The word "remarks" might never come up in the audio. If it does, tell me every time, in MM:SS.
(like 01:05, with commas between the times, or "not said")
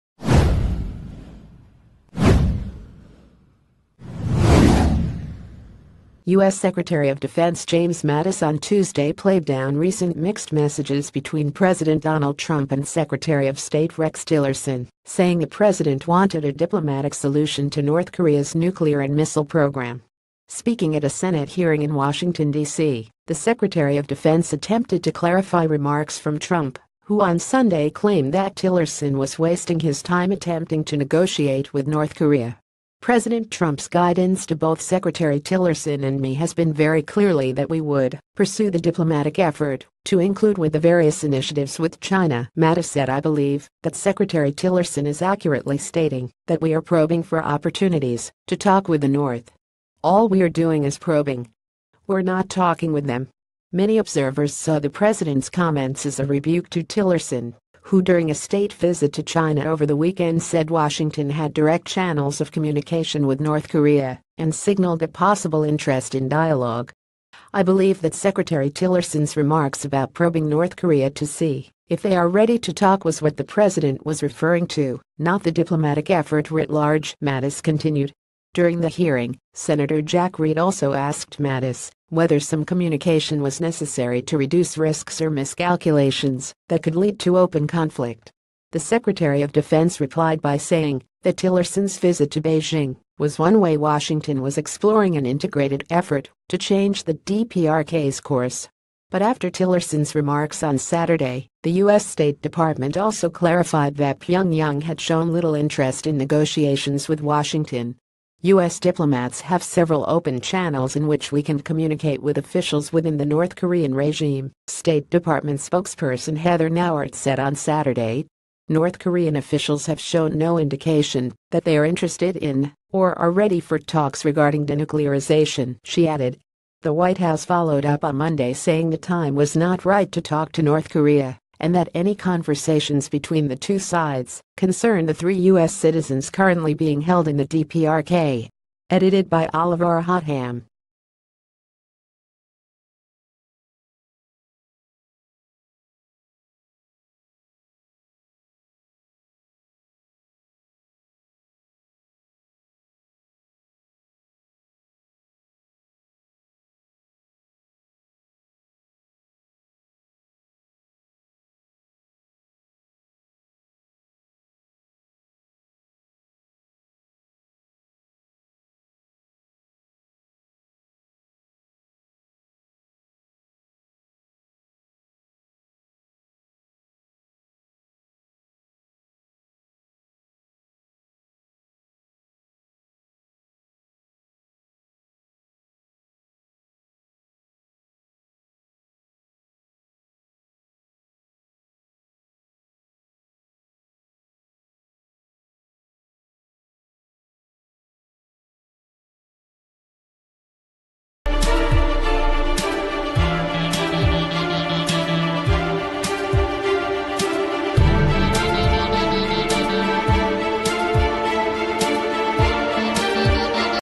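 00:25, 01:09, 01:40.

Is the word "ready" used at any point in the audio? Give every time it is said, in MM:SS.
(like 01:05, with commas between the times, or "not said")
01:12, 02:03.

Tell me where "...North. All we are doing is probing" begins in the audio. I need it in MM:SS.
00:49.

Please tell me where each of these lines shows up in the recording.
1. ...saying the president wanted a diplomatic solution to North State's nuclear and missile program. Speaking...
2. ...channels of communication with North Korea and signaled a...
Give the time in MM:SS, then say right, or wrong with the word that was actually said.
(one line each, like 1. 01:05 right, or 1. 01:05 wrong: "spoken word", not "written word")
1. 00:15 wrong: "Korea", not "State"
2. 01:01 right.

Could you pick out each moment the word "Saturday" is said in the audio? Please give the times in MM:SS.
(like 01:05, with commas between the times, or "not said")
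01:40, 01:57.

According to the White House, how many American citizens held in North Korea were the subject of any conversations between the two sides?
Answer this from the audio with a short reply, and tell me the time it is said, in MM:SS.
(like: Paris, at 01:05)
3, at 02:15.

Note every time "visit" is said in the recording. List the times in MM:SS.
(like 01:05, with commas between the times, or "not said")
00:58, 01:31.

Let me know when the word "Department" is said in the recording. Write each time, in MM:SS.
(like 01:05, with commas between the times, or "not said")
01:42, 01:55.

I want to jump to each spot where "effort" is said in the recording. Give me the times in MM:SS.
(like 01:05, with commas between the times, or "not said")
00:39, 01:16, 01:35.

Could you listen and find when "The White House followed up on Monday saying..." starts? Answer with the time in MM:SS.
02:06.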